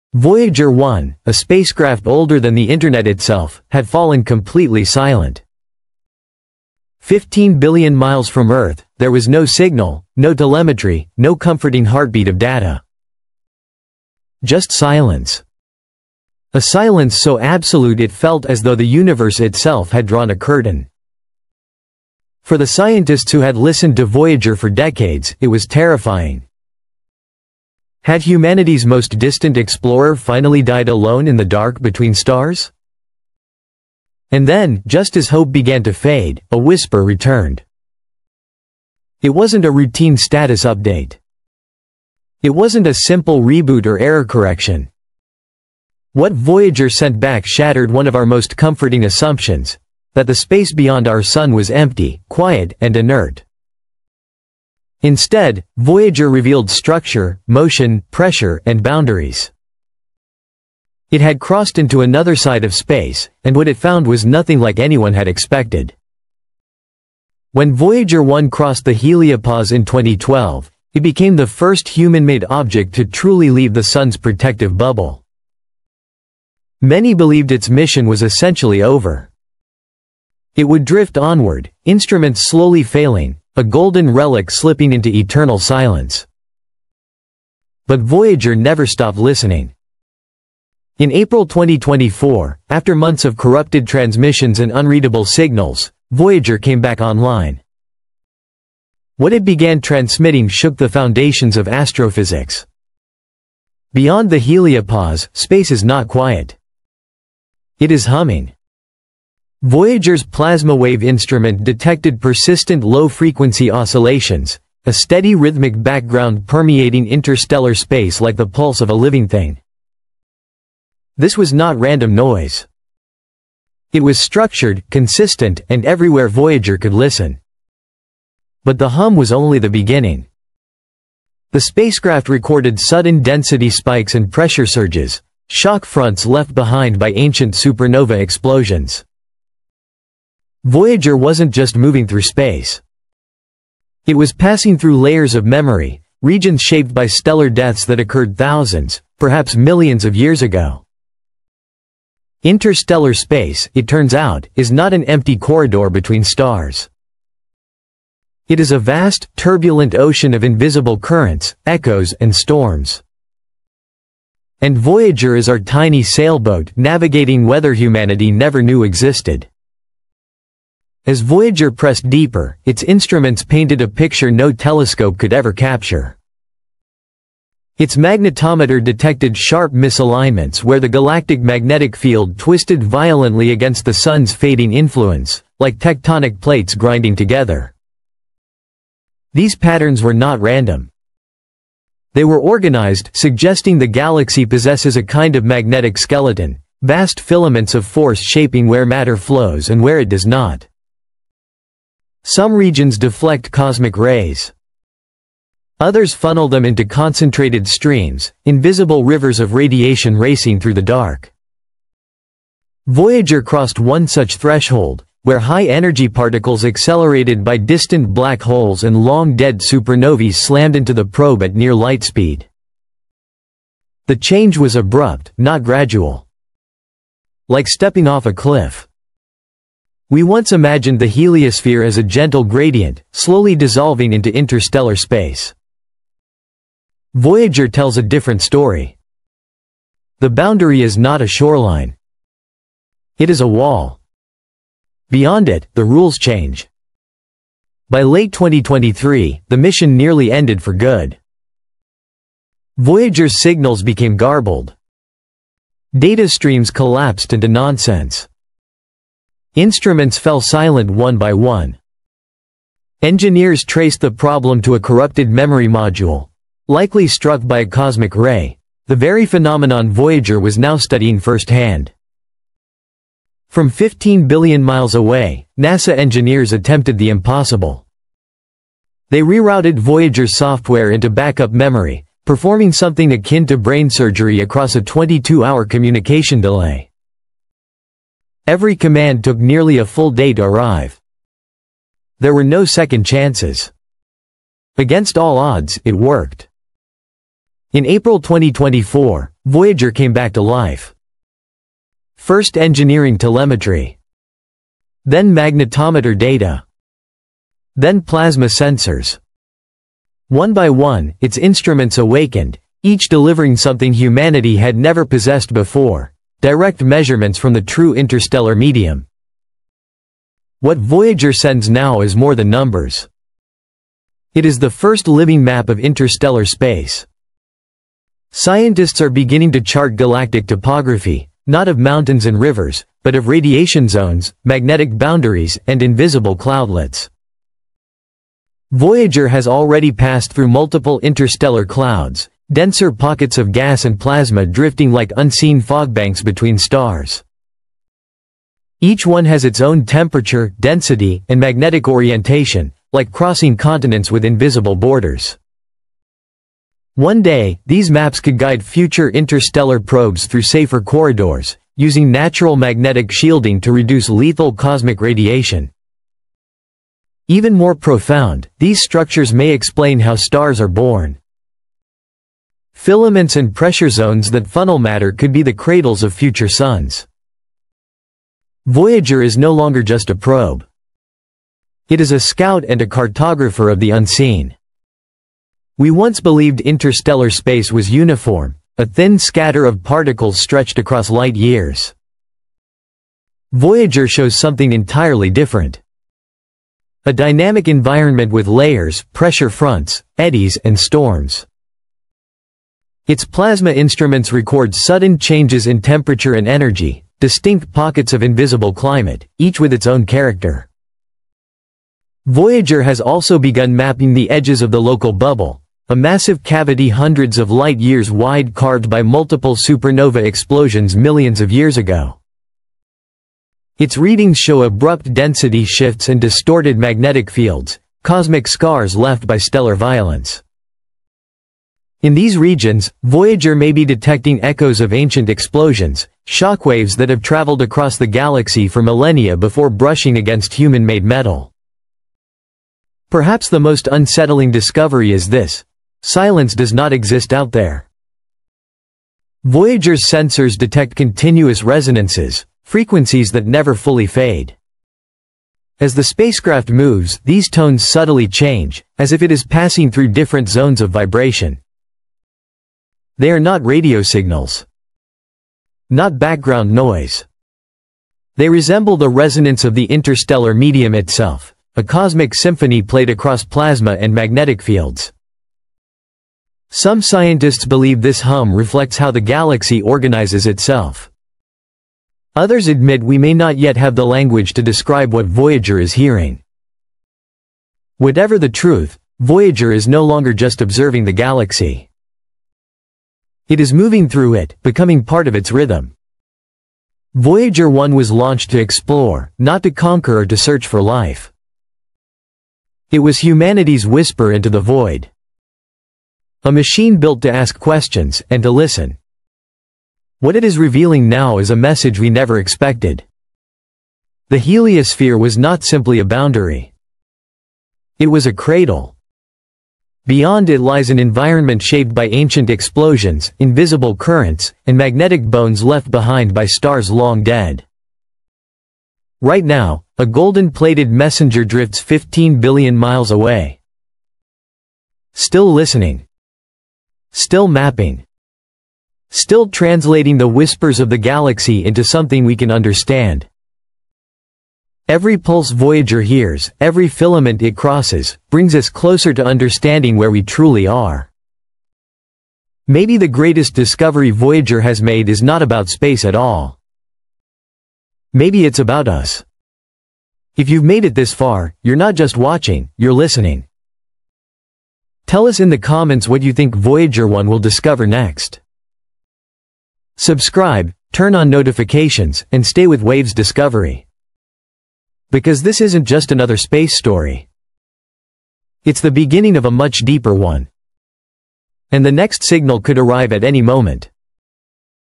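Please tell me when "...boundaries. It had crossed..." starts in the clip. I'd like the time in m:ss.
0:58.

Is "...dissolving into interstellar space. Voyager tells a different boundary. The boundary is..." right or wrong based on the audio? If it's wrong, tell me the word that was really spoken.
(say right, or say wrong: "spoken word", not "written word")
wrong: "story", not "boundary".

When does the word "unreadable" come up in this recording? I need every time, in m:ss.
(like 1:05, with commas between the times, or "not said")
1:34.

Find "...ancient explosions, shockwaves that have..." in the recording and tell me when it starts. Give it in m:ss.
7:14.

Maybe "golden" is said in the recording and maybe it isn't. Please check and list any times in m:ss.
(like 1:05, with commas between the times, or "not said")
1:23, 8:50.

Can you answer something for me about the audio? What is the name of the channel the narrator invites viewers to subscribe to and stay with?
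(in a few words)
Waves Discovery.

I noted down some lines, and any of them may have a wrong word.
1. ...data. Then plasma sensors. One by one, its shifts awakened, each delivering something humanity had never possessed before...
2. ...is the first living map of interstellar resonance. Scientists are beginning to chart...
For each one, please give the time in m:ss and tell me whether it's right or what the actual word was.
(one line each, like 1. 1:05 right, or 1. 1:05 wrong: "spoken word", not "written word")
1. 5:06 wrong: "instruments", not "shifts"
2. 5:24 wrong: "space", not "resonance".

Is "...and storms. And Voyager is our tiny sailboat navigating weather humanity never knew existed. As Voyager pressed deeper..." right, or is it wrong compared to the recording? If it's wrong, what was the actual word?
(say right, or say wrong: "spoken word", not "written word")
right.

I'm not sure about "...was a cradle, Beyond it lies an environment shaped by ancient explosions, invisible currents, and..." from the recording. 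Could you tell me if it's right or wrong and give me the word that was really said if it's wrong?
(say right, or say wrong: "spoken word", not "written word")
right.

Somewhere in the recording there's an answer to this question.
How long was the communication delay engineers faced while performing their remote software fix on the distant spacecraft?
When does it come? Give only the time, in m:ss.
4:44.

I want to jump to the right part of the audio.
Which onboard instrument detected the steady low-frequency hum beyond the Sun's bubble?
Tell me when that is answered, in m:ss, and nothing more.
1:50.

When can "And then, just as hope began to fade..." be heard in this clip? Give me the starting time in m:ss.
0:34.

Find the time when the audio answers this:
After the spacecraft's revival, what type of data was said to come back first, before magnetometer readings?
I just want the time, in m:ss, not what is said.
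5:02.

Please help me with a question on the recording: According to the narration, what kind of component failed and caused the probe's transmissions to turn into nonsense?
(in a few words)
corrupted memory module.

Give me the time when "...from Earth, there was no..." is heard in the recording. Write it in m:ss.
0:08.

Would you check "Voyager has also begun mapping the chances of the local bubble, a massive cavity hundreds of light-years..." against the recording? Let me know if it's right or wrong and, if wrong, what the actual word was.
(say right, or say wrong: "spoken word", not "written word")
wrong: "edges", not "chances".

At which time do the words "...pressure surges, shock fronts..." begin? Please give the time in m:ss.
2:14.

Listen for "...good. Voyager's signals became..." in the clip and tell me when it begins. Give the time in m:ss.
4:10.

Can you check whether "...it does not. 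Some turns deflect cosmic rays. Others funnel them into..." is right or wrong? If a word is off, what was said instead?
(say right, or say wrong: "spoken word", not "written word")
wrong: "regions", not "turns".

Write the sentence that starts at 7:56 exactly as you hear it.
Some scientists believe this hum reflects how the galaxy organizes itself.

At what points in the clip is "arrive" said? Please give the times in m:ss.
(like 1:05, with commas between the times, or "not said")
4:50, 9:42.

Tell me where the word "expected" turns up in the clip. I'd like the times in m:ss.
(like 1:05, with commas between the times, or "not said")
1:05, 8:32.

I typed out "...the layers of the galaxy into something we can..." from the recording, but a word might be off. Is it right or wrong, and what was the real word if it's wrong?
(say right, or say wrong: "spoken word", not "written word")
wrong: "whispers", not "layers".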